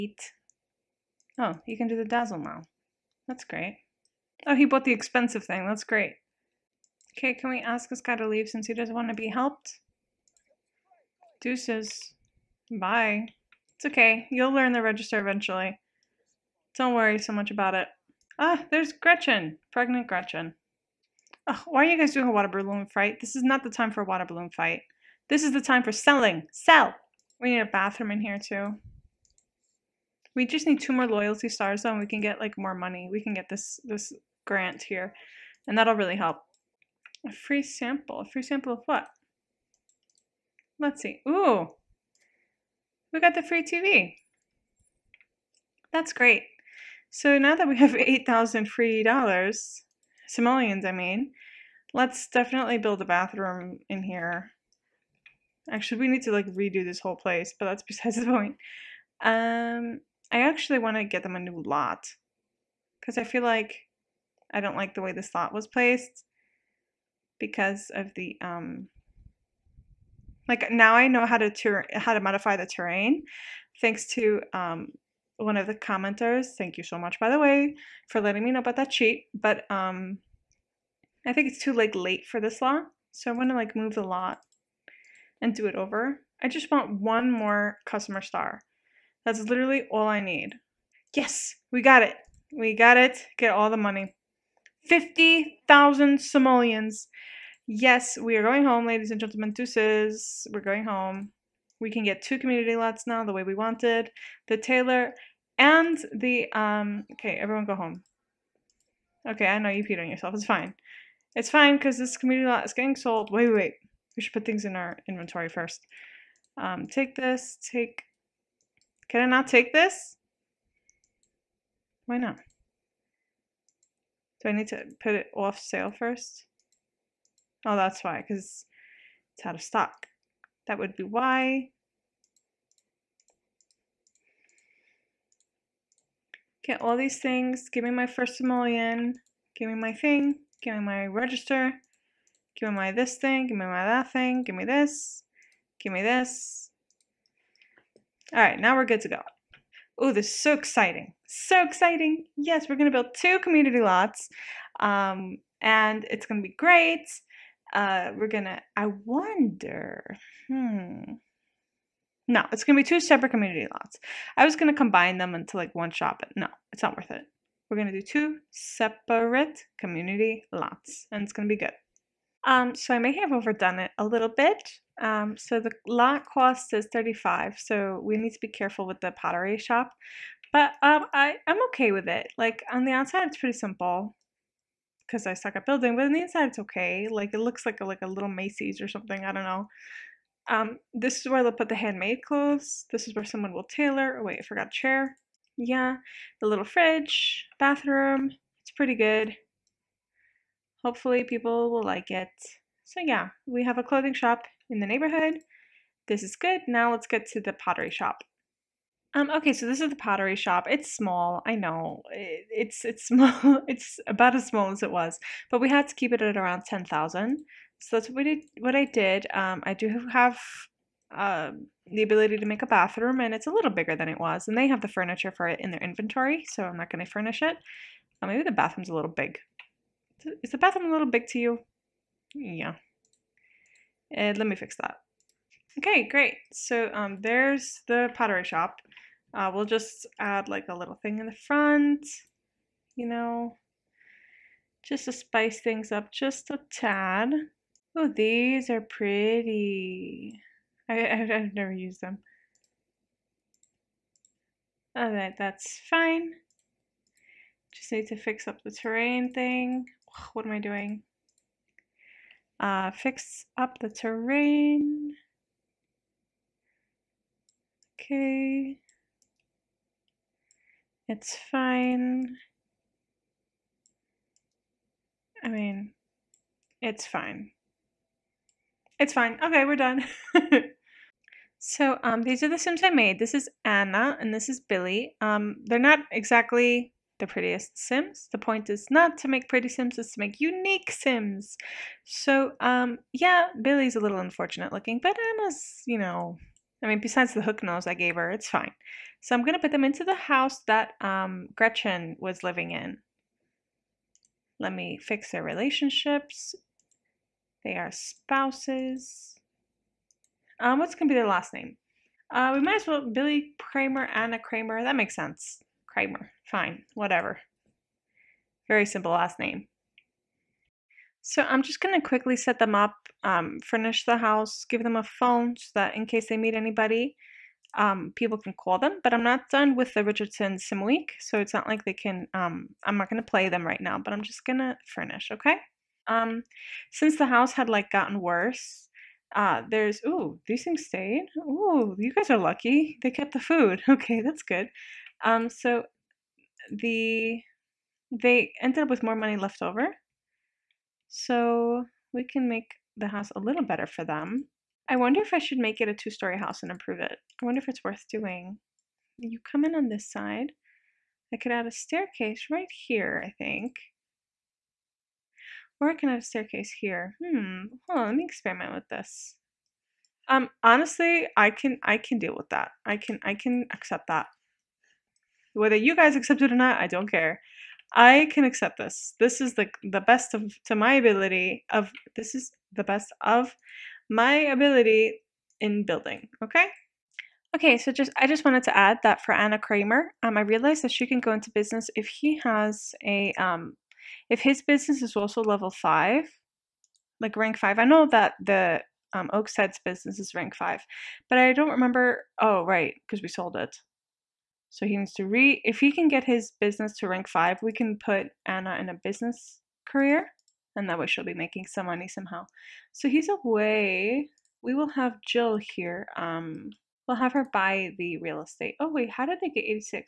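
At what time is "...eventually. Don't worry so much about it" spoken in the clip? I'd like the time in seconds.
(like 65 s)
15 s.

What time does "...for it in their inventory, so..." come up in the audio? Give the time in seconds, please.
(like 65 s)
225 s.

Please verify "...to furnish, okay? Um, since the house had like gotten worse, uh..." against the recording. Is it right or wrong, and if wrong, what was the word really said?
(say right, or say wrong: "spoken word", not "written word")
right.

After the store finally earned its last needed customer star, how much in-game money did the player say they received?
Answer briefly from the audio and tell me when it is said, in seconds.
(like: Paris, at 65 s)
50,000 simoleons, at 94 s.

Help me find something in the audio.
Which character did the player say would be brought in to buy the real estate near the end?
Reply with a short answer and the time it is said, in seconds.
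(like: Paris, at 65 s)
Jill, at 415 s.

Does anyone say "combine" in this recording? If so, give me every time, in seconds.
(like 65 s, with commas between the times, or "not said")
164 s.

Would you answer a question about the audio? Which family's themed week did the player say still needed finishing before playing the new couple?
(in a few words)
Richardson.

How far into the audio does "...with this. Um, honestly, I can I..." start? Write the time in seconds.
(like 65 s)
368 s.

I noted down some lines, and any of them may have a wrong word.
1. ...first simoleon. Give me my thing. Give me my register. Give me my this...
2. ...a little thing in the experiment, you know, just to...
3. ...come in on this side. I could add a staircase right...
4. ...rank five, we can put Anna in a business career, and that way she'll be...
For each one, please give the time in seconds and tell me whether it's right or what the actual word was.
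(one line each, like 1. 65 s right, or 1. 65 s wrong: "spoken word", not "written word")
1. 138 s right
2. 240 s wrong: "front", not "experiment"
3. 359 s right
4. 407 s right.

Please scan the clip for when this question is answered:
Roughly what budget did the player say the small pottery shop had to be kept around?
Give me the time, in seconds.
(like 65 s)
216 s.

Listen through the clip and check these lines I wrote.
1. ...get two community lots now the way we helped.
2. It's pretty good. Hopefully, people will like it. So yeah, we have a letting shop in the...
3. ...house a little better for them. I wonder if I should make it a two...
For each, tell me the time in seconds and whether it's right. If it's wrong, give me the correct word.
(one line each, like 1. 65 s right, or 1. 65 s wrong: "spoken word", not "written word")
1. 102 s wrong: "wanted", not "helped"
2. 198 s wrong: "clothing", not "letting"
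3. 353 s right.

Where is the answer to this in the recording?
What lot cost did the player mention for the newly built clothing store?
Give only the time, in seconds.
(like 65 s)
176 s.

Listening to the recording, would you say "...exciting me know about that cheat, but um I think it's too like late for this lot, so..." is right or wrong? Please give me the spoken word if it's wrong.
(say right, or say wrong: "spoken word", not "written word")
wrong: "letting", not "exciting".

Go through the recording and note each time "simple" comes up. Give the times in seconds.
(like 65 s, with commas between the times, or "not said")
183 s, 318 s.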